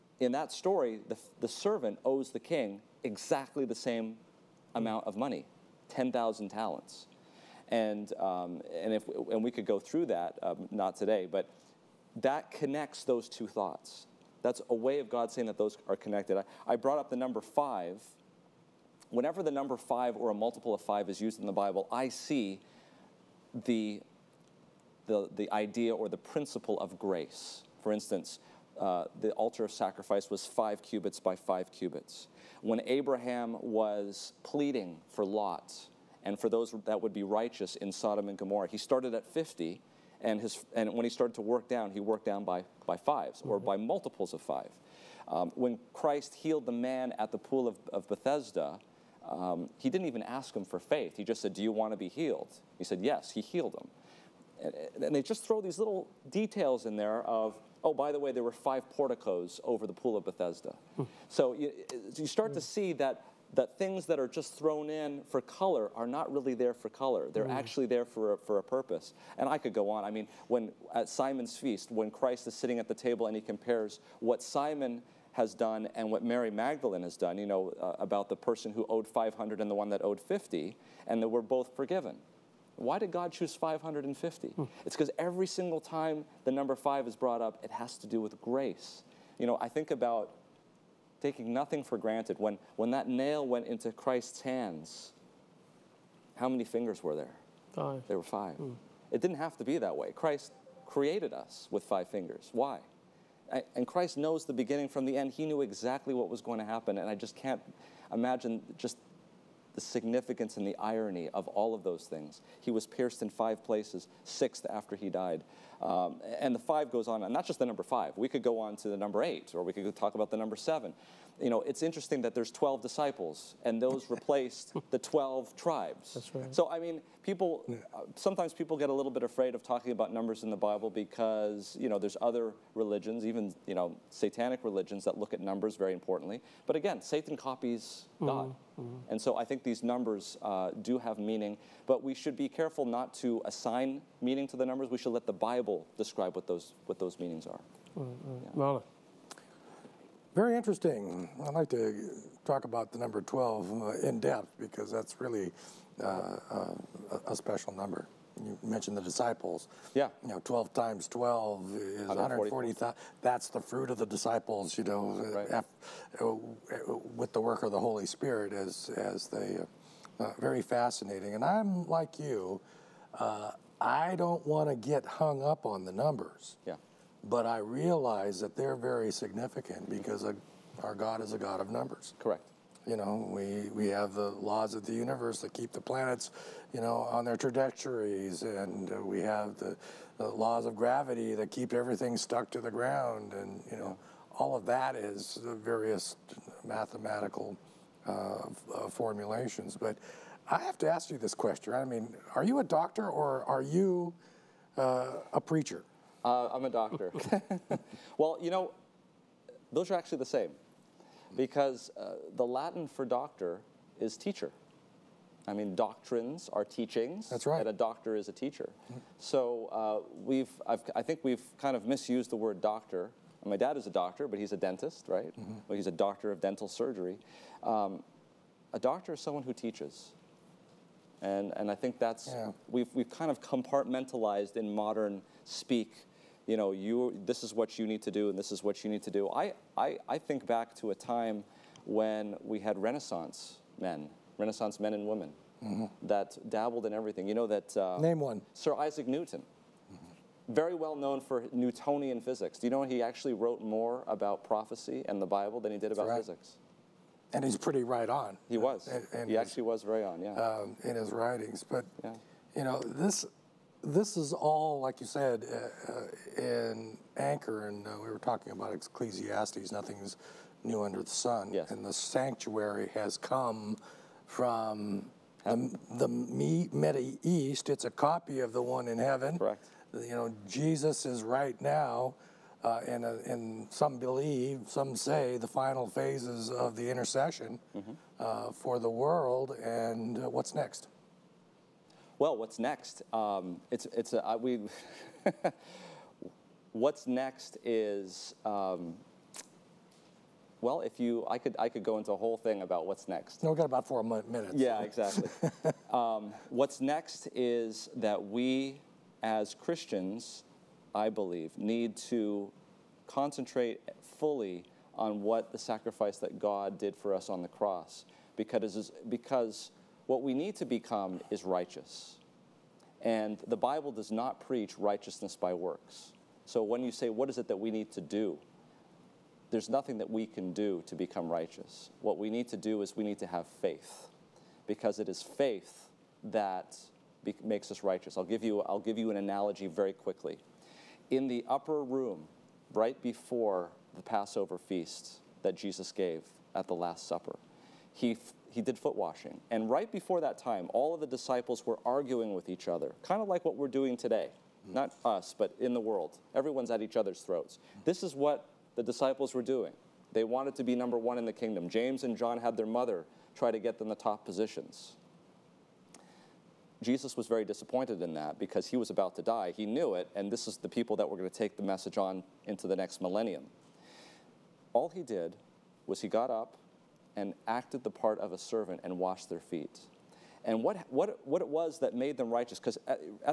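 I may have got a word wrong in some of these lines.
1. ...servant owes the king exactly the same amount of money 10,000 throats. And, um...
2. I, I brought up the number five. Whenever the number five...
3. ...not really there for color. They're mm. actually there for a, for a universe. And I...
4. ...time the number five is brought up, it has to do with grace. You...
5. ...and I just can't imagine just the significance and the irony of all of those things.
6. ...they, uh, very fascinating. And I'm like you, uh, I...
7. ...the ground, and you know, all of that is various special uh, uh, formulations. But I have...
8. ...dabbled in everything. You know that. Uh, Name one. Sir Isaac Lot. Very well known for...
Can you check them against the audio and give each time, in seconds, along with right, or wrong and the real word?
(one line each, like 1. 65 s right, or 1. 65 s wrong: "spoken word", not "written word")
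1. 1 s wrong: "talents", not "throats"
2. 16 s right
3. 66 s wrong: "purpose", not "universe"
4. 85 s right
5. 106 s right
6. 169 s right
7. 192 s wrong: "mathematical", not "special"
8. 246 s wrong: "Newton", not "Lot".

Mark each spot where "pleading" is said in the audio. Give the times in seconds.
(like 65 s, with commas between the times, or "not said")
34 s.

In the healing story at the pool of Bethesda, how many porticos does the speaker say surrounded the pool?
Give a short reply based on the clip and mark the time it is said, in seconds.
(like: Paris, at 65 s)
5, at 58 s.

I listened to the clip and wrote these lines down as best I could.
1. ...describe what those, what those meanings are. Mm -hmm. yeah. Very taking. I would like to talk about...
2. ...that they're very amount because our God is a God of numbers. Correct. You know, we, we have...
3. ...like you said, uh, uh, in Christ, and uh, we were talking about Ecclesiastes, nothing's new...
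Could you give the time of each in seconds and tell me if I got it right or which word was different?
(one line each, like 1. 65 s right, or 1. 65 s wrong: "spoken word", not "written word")
1. 145 s wrong: "interesting", not "taking"
2. 178 s wrong: "significant", not "amount"
3. 264 s wrong: "Anchor", not "Christ".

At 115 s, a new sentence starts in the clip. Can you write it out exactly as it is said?
Um, and the five goes on, and not just the number five.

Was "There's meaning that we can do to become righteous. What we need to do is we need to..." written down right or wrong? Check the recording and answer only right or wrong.
wrong.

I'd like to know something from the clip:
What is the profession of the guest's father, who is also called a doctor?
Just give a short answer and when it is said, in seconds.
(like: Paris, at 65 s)
Dentist, at 224 s.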